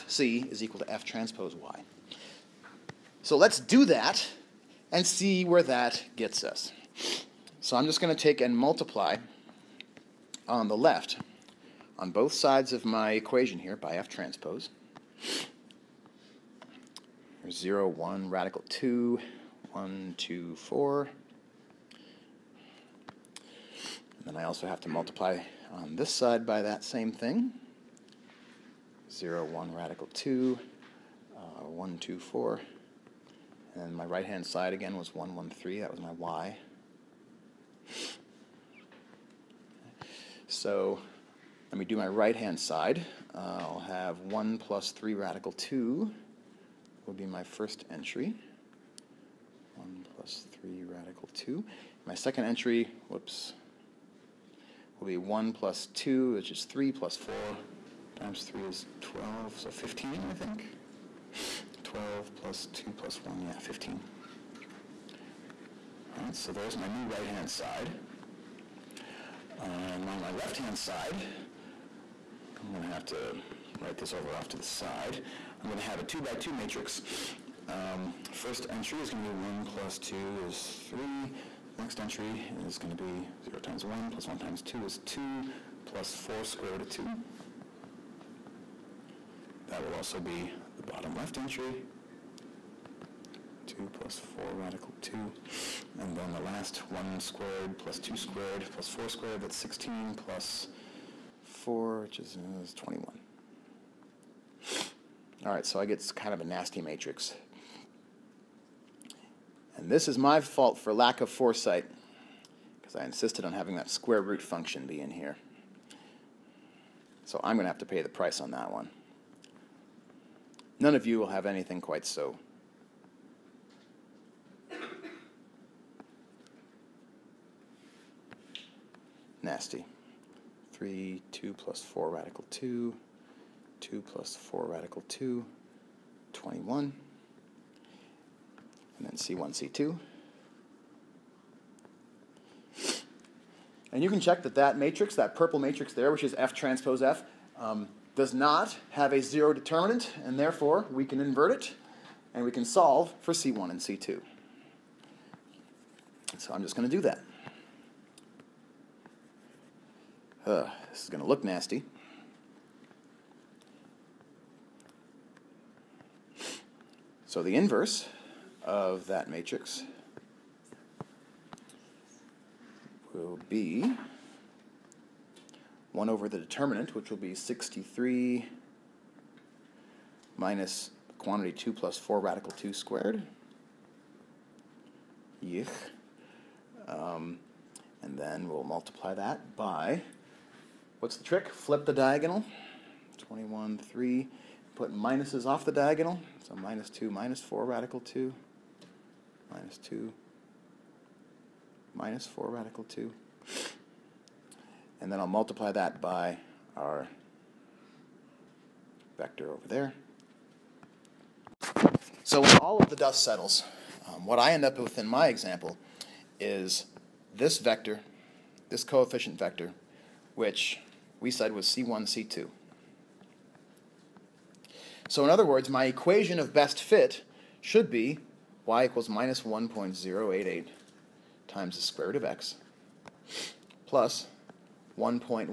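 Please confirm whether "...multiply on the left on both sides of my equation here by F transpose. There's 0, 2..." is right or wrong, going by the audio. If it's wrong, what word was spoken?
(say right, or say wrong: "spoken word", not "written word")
wrong: "1", not "2".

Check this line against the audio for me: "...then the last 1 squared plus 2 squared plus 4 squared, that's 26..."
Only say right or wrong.
wrong.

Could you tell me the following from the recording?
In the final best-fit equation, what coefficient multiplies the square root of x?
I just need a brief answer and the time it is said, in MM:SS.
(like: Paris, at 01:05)
-1.088, at 03:49.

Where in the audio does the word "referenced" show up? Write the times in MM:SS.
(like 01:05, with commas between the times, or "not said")
not said.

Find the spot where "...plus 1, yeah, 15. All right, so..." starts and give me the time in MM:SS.
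01:02.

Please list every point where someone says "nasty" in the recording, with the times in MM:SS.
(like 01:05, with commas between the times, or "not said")
01:46, 02:09, 02:41.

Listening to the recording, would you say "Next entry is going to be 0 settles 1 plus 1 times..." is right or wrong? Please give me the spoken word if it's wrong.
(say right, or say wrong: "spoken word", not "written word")
wrong: "times", not "settles".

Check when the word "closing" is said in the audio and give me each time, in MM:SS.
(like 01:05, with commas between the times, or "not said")
not said.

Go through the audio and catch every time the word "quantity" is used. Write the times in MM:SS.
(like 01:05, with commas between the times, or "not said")
03:01.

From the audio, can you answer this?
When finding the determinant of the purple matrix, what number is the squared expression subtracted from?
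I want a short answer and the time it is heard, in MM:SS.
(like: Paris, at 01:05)
63, at 02:57.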